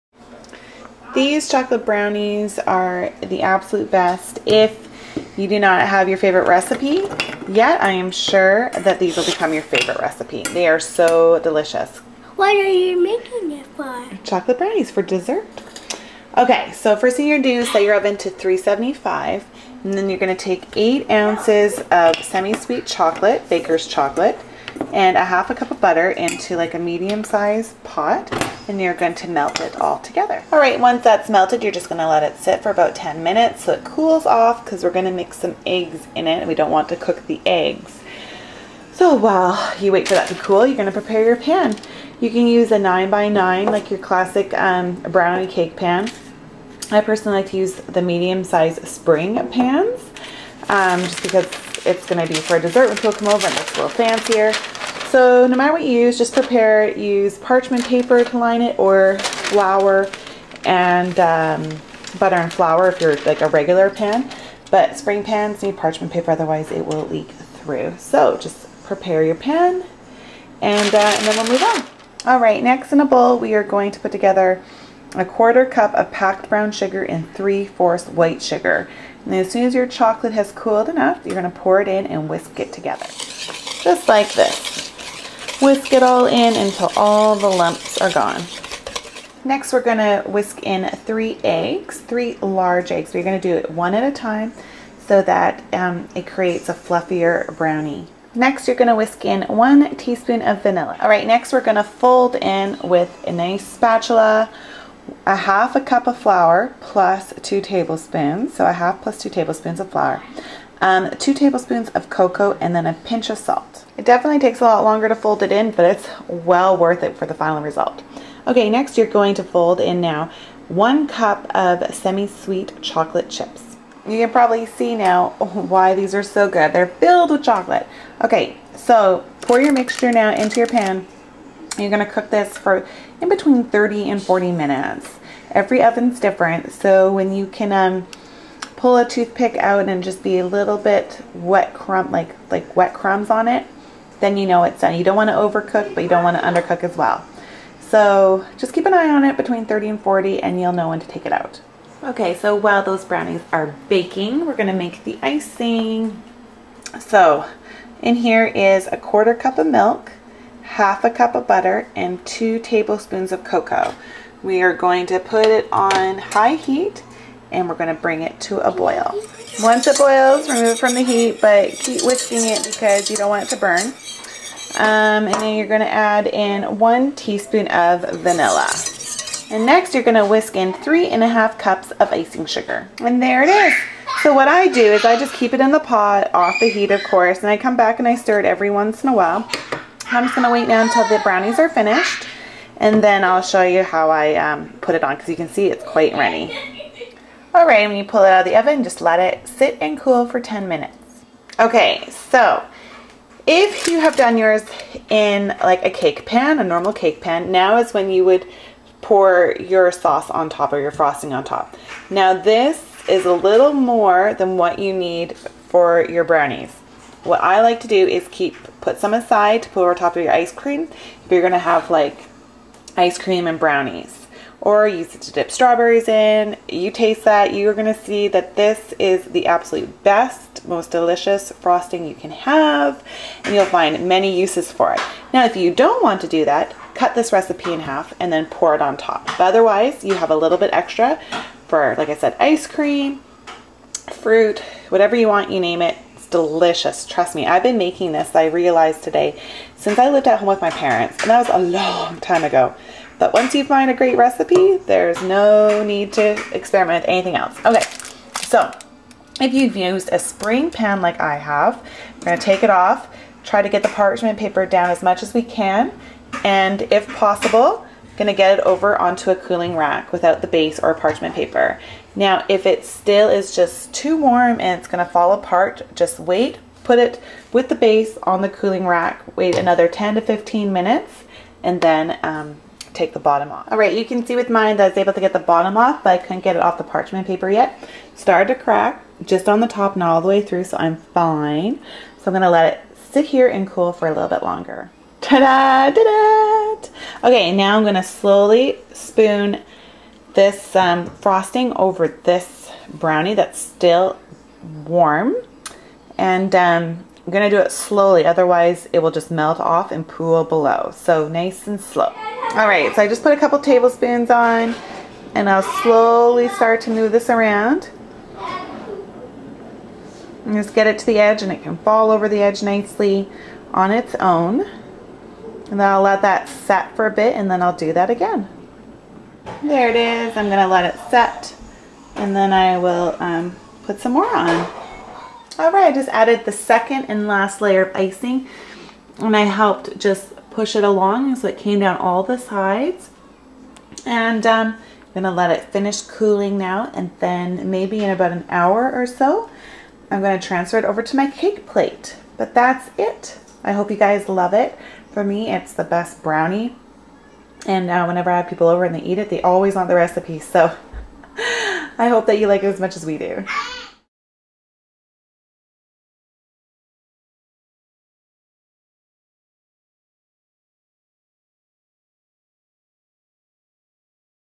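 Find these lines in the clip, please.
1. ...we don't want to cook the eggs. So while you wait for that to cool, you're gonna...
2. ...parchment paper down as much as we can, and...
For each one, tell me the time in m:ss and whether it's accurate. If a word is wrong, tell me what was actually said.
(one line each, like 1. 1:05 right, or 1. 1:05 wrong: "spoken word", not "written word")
1. 0:36 right
2. 4:23 right.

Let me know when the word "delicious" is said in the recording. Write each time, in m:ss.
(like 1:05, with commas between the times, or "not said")
0:11, 3:50, 4:06.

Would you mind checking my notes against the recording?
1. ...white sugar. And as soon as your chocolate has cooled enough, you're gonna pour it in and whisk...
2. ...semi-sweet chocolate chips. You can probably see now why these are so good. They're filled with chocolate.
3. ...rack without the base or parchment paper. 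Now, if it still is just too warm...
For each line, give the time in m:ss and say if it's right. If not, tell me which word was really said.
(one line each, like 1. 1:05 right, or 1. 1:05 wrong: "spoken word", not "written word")
1. 1:18 right
2. 2:01 right
3. 4:29 right.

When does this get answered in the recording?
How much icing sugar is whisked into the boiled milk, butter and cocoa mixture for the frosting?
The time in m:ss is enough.
3:00.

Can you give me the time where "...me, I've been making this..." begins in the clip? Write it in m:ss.
4:07.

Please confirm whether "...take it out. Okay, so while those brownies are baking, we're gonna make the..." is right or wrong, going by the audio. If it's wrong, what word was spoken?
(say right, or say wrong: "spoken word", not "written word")
right.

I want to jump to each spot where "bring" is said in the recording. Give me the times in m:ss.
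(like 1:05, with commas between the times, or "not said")
2:48.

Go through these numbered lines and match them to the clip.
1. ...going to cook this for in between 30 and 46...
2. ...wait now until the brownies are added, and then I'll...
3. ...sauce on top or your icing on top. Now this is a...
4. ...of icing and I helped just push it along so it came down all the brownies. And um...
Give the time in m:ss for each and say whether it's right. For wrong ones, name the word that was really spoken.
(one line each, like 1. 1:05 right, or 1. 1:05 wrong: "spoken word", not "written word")
1. 2:11 wrong: "40", not "46"
2. 3:10 wrong: "finished", not "added"
3. 3:29 wrong: "frosting", not "icing"
4. 5:37 wrong: "sides", not "brownies".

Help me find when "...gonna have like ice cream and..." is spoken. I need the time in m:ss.
3:41.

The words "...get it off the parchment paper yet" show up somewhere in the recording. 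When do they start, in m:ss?
4:46.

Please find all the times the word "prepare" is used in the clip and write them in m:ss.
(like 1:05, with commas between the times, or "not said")
0:40, 0:56, 1:08.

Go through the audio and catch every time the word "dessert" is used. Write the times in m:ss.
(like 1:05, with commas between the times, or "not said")
0:15, 0:52.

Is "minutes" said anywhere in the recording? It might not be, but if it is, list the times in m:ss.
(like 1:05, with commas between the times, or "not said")
0:33, 2:14, 3:20, 4:40.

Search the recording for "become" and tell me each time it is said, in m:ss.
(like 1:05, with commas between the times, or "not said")
0:09.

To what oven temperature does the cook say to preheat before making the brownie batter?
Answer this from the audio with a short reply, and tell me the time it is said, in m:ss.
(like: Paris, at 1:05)
375, at 0:18.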